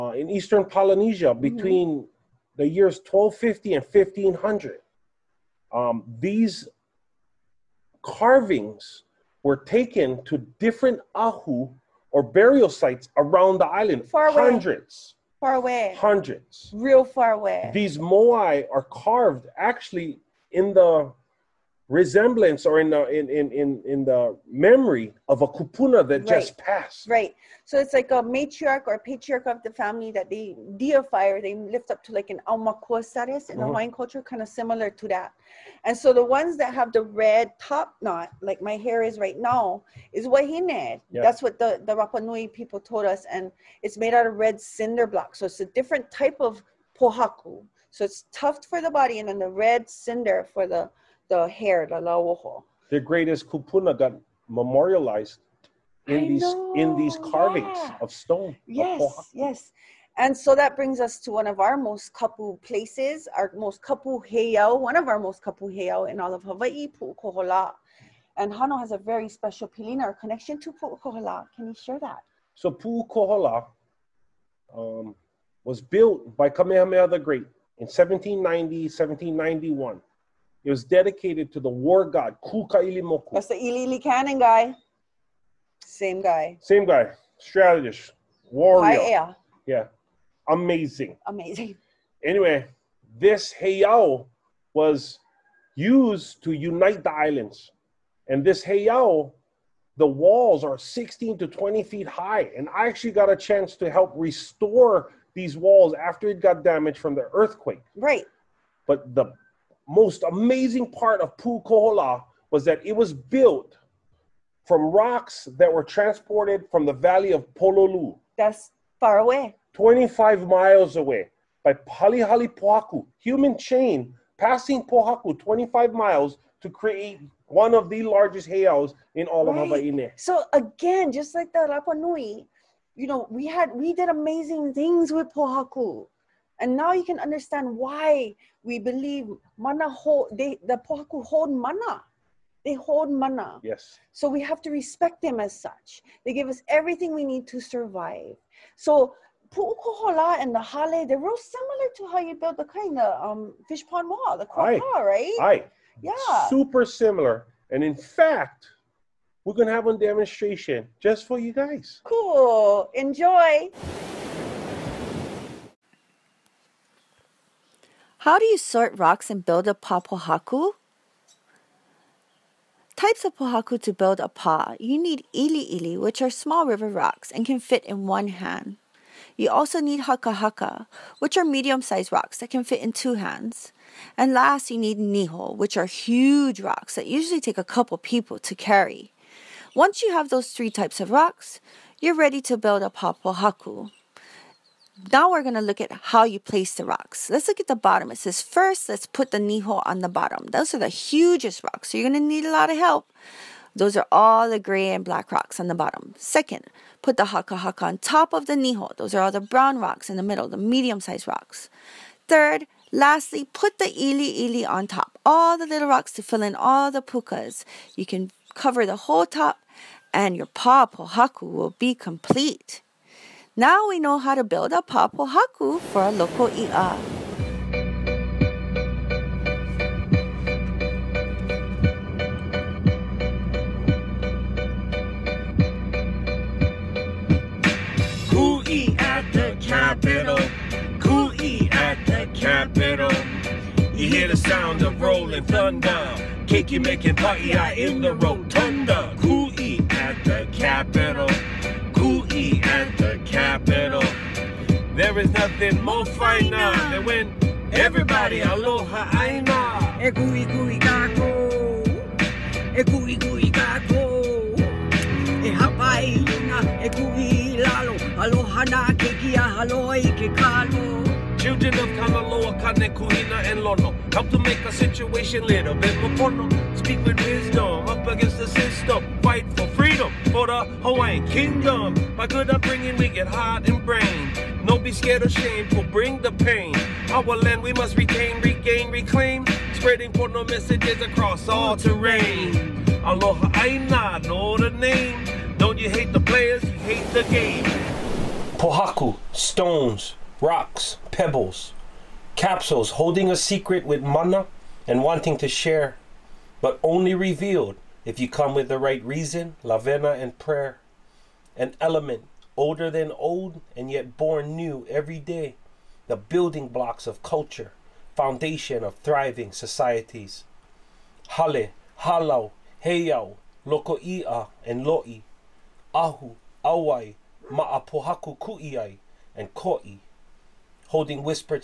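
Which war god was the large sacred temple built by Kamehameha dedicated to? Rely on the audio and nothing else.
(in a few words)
Kukailimoku.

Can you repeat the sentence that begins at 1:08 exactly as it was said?
And Hano has a very special pilina or connection to Pu'ukohola.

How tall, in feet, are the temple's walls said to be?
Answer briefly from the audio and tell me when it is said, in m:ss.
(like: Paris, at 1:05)
16 to 20 feet, at 1:40.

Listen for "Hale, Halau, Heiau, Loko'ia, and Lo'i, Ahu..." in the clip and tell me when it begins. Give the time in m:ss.
5:21.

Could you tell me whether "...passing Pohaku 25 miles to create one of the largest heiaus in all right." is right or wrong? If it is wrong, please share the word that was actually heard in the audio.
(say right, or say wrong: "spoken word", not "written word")
right.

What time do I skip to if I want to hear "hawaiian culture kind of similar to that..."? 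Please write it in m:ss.
0:33.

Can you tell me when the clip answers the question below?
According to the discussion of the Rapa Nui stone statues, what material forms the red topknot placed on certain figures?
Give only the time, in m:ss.
0:44.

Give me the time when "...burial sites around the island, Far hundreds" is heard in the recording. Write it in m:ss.
0:12.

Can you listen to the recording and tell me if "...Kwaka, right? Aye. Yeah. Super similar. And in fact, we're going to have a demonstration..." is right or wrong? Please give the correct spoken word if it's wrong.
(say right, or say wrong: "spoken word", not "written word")
right.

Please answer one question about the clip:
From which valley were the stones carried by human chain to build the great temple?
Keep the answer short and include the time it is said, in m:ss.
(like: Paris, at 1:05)
Pololu, at 1:57.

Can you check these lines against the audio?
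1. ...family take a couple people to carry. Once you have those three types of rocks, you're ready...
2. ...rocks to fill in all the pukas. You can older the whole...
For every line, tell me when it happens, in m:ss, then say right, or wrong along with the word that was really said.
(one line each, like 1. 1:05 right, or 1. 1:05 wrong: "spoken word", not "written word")
1. 3:07 wrong: "usually", not "family"
2. 3:35 wrong: "cover", not "older".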